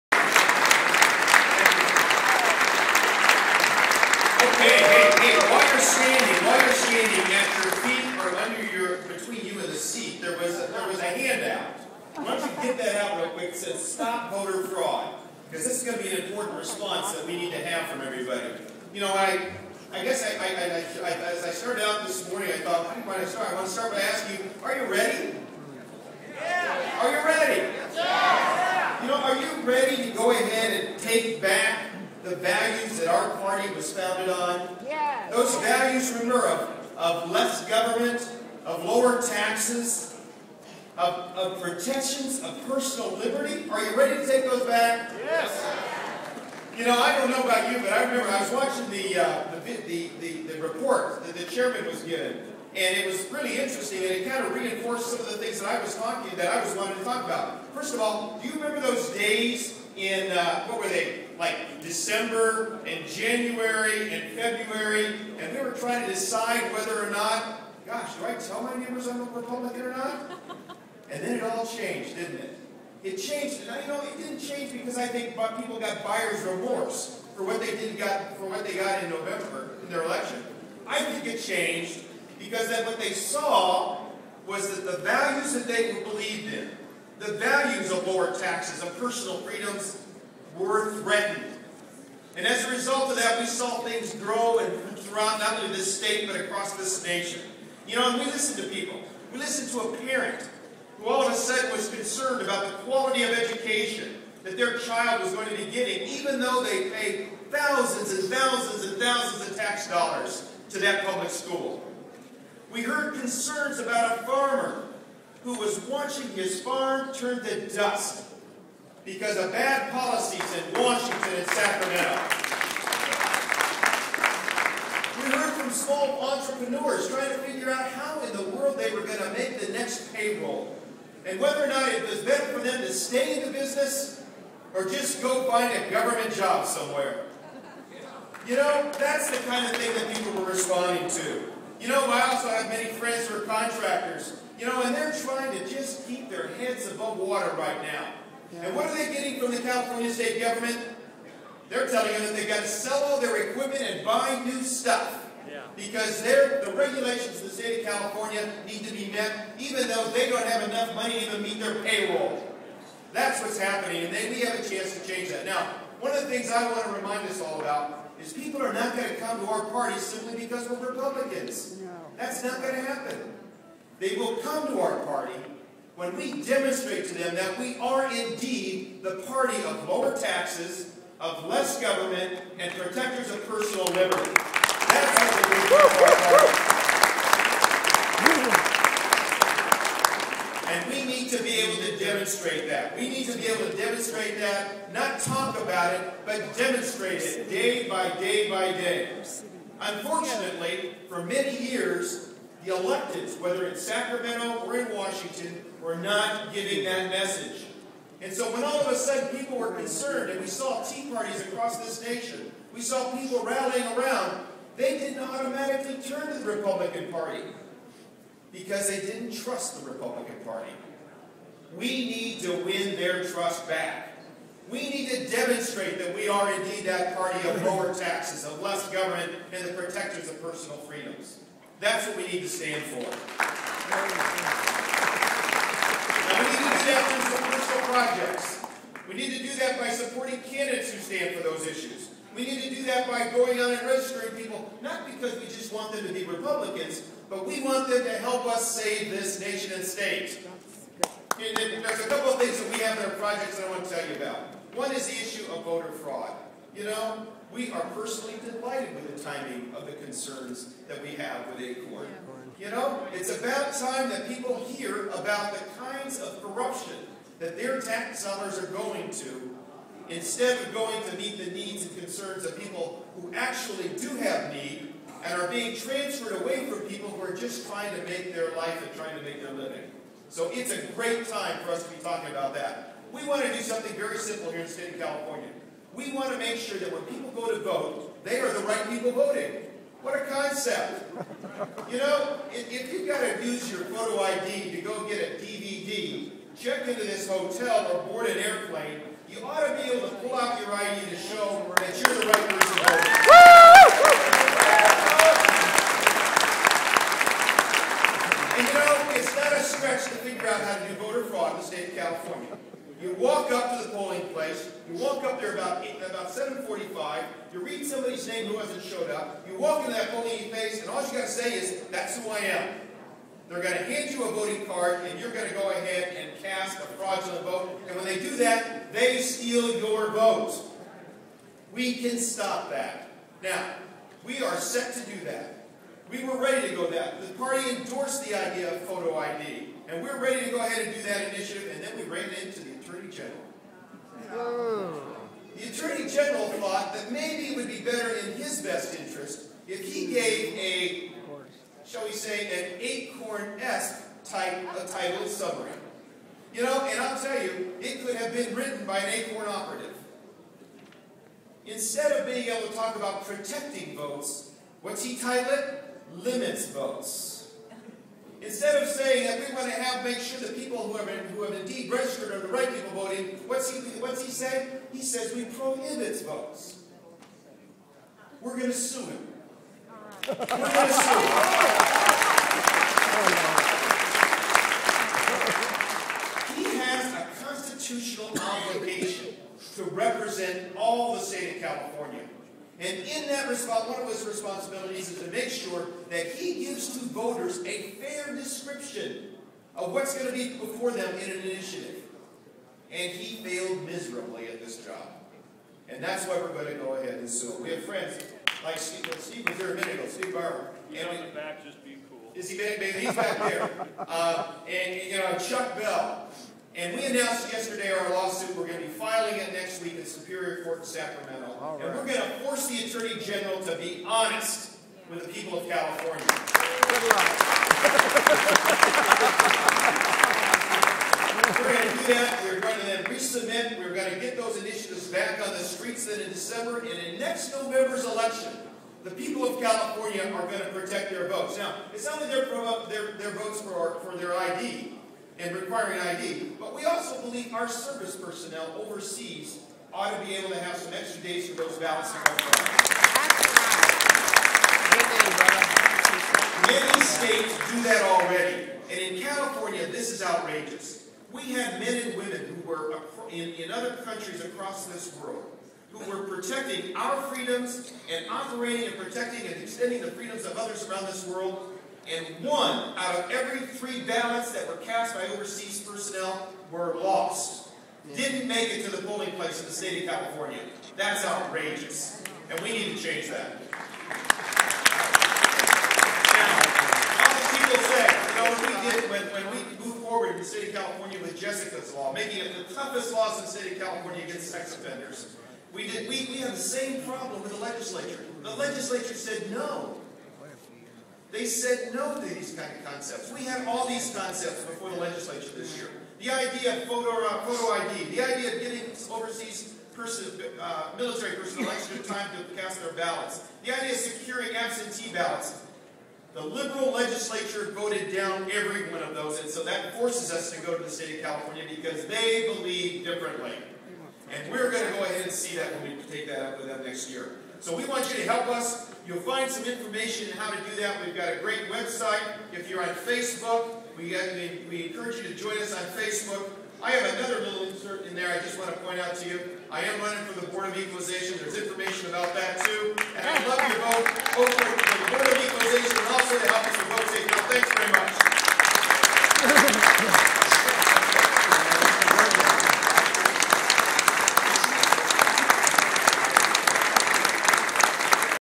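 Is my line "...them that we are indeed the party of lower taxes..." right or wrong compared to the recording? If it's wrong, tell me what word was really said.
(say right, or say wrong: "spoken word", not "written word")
right.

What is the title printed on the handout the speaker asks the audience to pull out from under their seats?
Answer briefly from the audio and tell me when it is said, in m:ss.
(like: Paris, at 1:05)
Stop Voter Fraud, at 0:13.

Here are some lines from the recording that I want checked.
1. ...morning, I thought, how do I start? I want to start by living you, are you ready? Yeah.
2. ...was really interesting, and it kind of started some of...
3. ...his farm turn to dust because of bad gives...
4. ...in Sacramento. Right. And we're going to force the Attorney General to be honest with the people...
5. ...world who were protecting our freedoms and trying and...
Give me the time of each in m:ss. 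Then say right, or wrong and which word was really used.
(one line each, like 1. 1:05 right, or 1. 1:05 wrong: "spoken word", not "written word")
1. 0:22 wrong: "asking", not "living"
2. 0:53 wrong: "reinforced", not "started"
3. 1:56 wrong: "policies", not "gives"
4. 7:00 right
5. 7:45 wrong: "operating", not "trying".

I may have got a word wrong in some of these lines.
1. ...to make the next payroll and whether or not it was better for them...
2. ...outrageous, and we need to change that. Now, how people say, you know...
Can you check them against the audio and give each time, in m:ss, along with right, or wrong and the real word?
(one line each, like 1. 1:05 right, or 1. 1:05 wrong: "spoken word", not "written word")
1. 2:09 right
2. 8:01 right.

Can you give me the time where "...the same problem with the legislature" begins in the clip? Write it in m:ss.
8:16.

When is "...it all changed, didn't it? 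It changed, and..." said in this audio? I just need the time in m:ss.
1:11.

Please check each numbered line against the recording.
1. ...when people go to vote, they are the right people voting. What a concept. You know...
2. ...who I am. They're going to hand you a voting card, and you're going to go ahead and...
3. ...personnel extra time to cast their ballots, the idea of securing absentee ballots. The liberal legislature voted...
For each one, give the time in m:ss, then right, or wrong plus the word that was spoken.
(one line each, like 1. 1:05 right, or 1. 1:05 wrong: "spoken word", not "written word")
1. 4:46 right
2. 5:22 right
3. 8:31 right.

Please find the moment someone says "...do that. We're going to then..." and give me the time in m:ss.
7:11.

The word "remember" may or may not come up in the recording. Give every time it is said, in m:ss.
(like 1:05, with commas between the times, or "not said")
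0:36, 0:48, 0:58.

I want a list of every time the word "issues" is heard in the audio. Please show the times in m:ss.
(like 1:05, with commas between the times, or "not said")
4:01, 4:15.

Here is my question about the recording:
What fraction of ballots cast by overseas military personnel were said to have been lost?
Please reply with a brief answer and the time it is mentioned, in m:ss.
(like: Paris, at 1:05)
1 out of every 3, at 7:52.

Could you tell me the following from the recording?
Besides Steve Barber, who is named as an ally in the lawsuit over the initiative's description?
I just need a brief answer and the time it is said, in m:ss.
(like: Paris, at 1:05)
Chuck Bell, at 6:55.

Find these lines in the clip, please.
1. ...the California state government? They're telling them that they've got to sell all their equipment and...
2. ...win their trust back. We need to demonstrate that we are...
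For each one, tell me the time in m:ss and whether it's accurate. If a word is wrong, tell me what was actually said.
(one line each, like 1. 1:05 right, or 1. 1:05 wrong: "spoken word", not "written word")
1. 2:29 right
2. 3:42 right.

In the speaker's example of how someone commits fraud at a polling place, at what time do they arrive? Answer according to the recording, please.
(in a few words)
7:45.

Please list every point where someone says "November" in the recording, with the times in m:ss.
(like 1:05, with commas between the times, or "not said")
1:19, 7:17.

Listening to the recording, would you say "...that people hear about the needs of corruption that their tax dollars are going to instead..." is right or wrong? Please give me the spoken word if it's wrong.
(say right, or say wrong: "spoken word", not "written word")
wrong: "kinds", not "needs".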